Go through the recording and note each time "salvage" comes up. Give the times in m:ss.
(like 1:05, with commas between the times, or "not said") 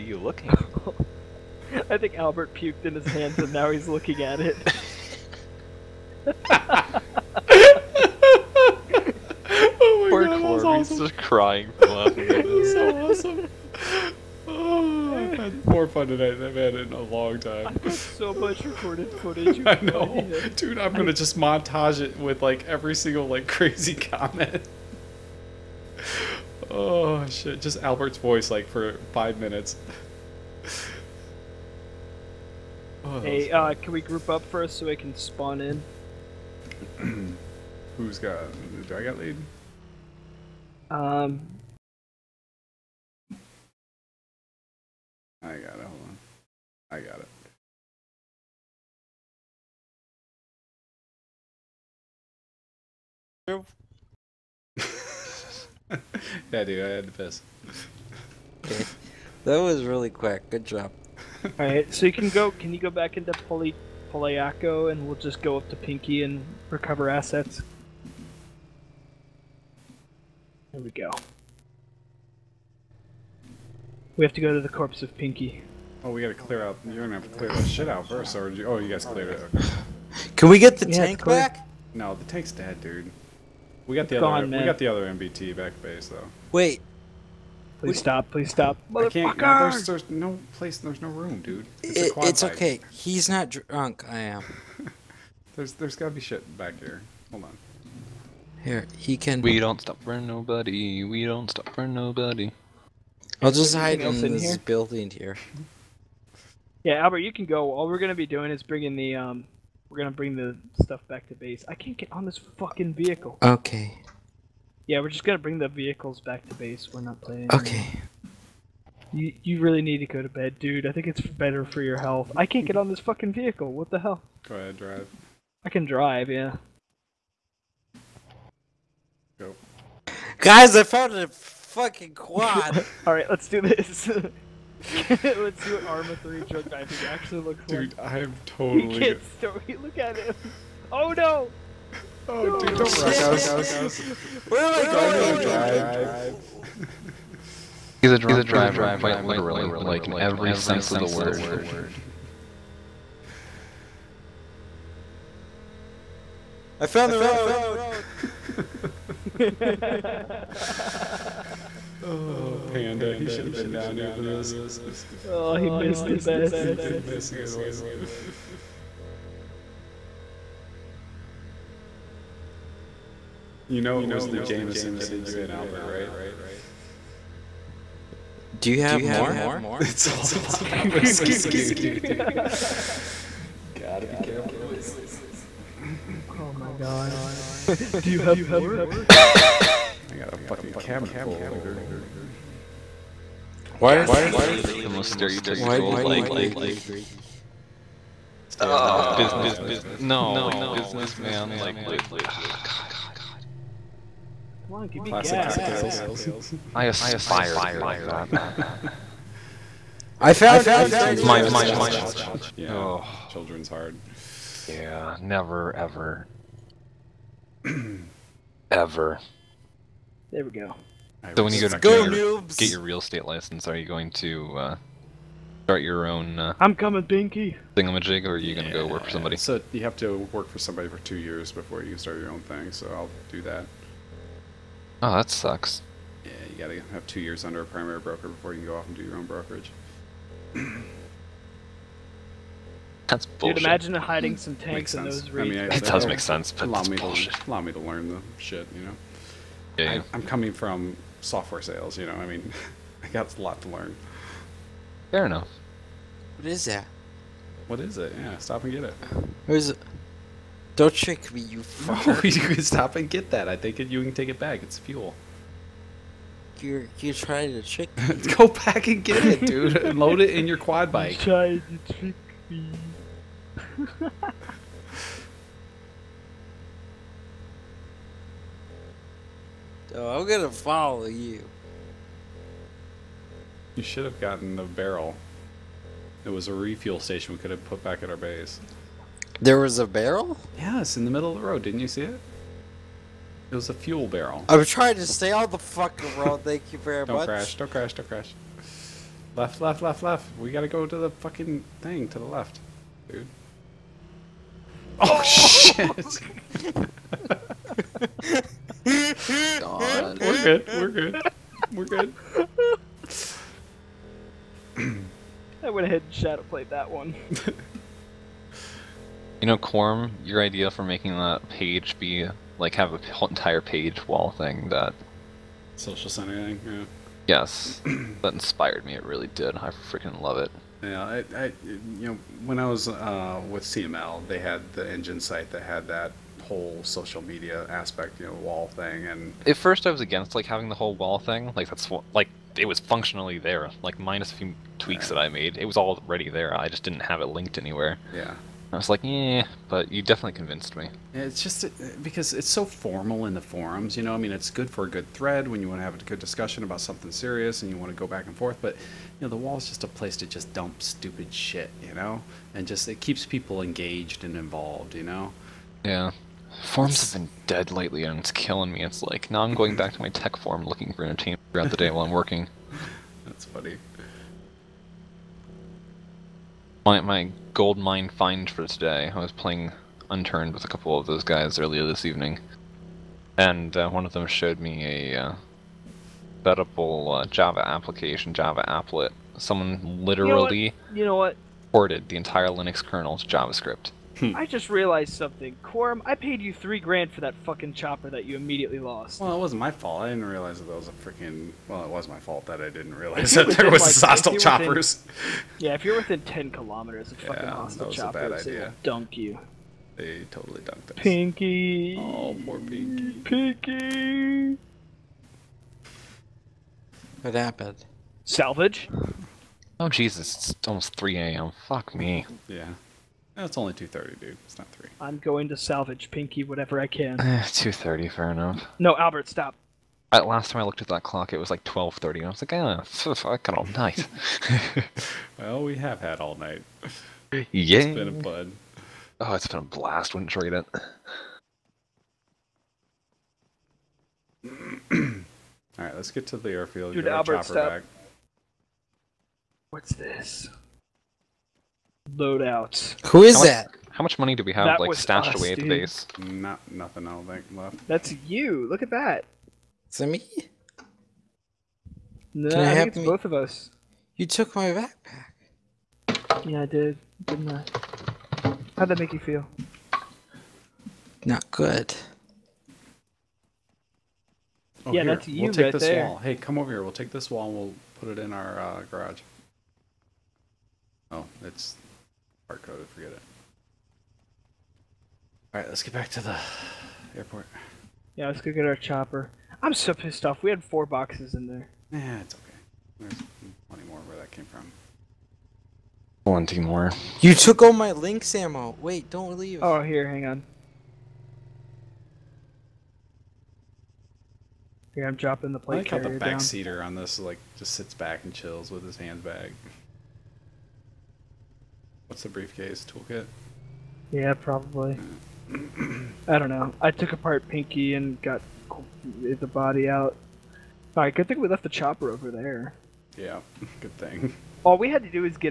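6:58, 7:05.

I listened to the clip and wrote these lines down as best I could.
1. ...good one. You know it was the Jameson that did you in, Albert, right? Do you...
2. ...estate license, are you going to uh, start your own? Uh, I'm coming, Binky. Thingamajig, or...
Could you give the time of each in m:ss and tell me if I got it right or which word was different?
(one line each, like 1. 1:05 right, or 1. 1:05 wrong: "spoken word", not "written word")
1. 2:47 right
2. 3:42 right.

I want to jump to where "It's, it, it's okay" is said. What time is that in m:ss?
1:31.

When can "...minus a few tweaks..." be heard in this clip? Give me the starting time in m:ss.
5:43.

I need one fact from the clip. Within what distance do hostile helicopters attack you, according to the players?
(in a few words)
10 kilometers.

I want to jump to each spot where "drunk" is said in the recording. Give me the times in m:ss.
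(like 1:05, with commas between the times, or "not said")
1:33, 2:28.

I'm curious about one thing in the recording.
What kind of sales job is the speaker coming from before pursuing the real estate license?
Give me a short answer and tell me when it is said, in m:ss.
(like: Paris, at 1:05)
software sales, at 4:11.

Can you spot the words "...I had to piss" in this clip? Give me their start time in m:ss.
0:56.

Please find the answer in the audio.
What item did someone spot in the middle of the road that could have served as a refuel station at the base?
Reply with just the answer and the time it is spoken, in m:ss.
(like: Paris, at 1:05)
fuel barrel, at 4:53.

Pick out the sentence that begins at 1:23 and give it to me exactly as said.
We got it's the gone, other.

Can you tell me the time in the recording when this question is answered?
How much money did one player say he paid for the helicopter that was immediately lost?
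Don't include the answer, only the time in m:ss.
6:36.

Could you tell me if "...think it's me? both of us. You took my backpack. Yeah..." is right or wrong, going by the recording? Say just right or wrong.
right.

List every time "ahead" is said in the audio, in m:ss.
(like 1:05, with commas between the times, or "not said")
2:04, 5:15.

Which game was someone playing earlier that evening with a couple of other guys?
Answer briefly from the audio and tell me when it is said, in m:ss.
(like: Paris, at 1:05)
Unturned, at 6:20.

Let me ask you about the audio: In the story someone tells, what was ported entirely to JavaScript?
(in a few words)
Linux kernel.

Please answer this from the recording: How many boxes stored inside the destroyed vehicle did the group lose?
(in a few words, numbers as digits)
4.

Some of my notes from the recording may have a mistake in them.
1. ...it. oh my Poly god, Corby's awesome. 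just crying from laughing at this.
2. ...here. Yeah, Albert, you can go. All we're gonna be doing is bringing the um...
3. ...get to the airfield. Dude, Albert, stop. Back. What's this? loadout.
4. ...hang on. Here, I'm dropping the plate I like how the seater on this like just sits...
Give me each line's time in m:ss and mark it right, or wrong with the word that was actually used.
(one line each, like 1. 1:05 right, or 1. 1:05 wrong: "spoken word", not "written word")
1. 0:04 wrong: "Poor", not "Poly"
2. 1:45 right
3. 7:26 right
4. 8:20 right.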